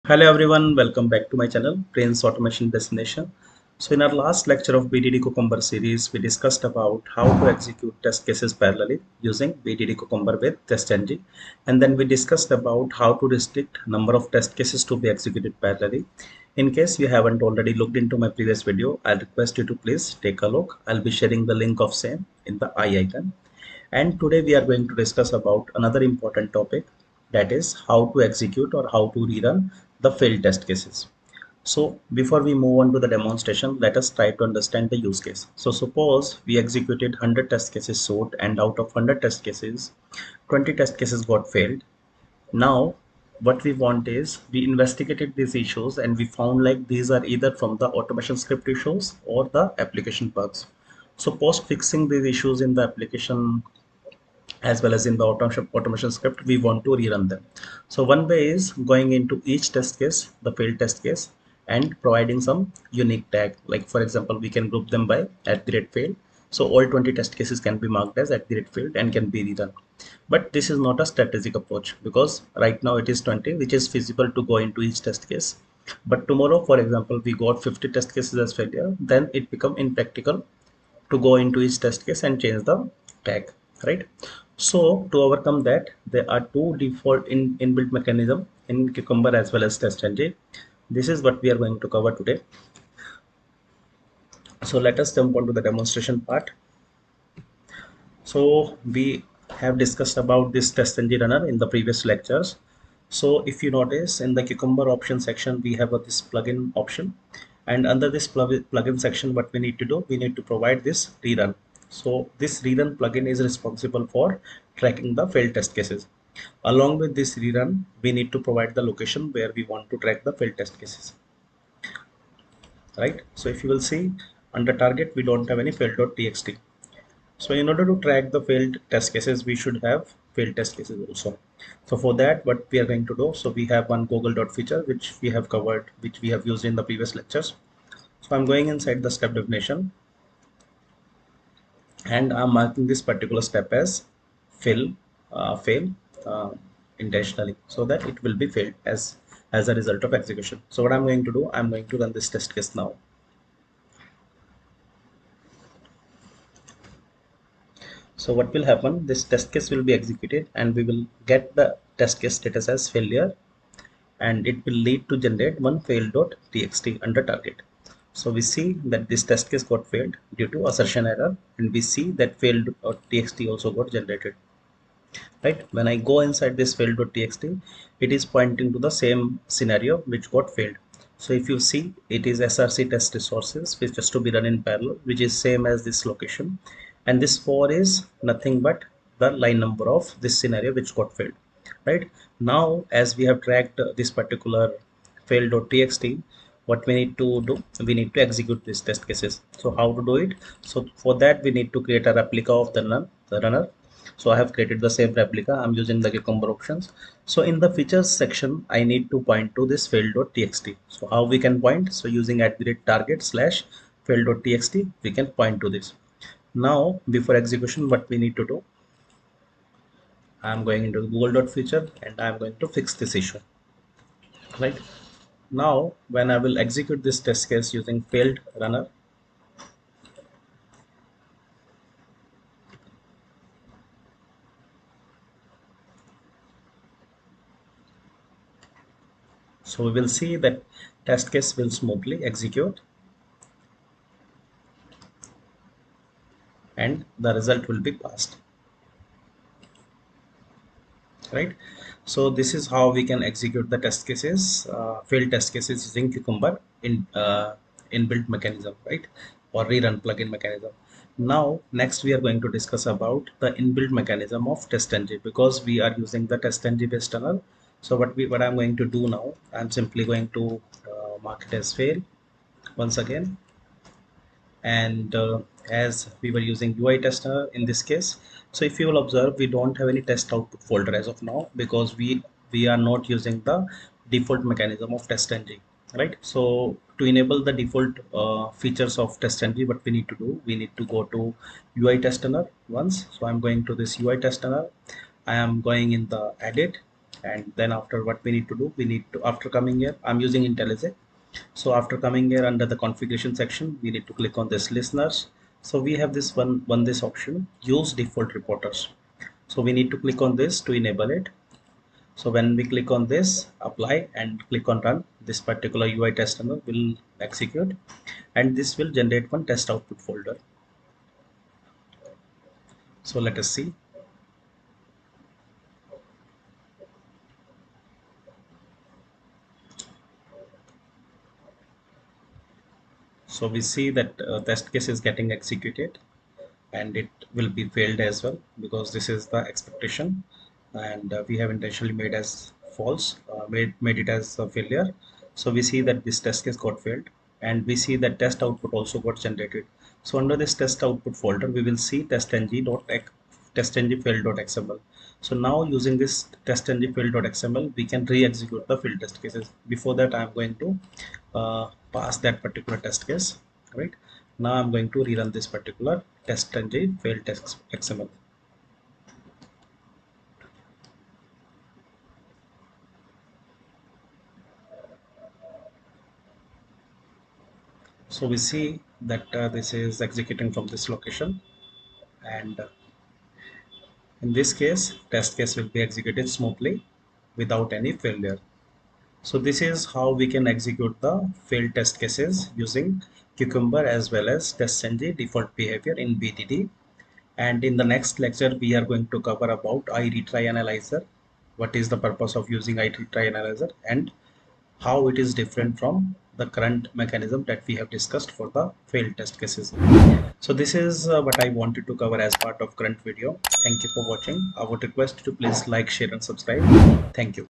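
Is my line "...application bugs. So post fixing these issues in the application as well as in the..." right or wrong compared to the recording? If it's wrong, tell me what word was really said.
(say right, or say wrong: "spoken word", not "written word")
right.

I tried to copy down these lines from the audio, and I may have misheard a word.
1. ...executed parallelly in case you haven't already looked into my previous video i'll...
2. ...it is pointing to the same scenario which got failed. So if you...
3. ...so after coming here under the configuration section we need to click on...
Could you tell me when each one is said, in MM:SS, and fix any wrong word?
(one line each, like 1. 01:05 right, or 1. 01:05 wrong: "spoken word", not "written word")
1. 00:15 right
2. 02:57 right
3. 05:01 right.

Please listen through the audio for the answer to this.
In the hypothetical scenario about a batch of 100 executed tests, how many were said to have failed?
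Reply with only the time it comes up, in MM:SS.
00:40.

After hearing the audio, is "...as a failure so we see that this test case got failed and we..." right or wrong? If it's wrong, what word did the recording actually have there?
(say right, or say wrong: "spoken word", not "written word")
right.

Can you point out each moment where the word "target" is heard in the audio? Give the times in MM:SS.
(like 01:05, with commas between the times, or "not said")
02:04, 02:47, 03:32.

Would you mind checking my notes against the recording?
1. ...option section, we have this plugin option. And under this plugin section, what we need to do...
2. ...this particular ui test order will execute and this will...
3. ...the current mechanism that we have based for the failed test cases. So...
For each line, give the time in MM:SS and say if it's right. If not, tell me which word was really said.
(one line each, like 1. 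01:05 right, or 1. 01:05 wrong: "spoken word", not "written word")
1. 01:44 right
2. 05:15 wrong: "runner", not "order"
3. 06:46 wrong: "discussed", not "based".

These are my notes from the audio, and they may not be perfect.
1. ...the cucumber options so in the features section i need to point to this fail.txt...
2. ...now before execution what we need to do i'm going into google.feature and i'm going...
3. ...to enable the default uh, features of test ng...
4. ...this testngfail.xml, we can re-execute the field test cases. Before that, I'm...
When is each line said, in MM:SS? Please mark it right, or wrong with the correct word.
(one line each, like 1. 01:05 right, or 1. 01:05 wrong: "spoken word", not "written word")
1. 03:25 right
2. 03:36 right
3. 04:46 right
4. 05:55 right.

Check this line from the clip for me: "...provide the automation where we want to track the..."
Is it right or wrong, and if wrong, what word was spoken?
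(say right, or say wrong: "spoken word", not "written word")
wrong: "location", not "automation".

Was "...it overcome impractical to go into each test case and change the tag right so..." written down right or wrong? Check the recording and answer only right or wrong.
wrong.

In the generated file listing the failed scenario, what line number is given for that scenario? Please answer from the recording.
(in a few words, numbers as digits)
4.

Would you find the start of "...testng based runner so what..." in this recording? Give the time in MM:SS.
04:26.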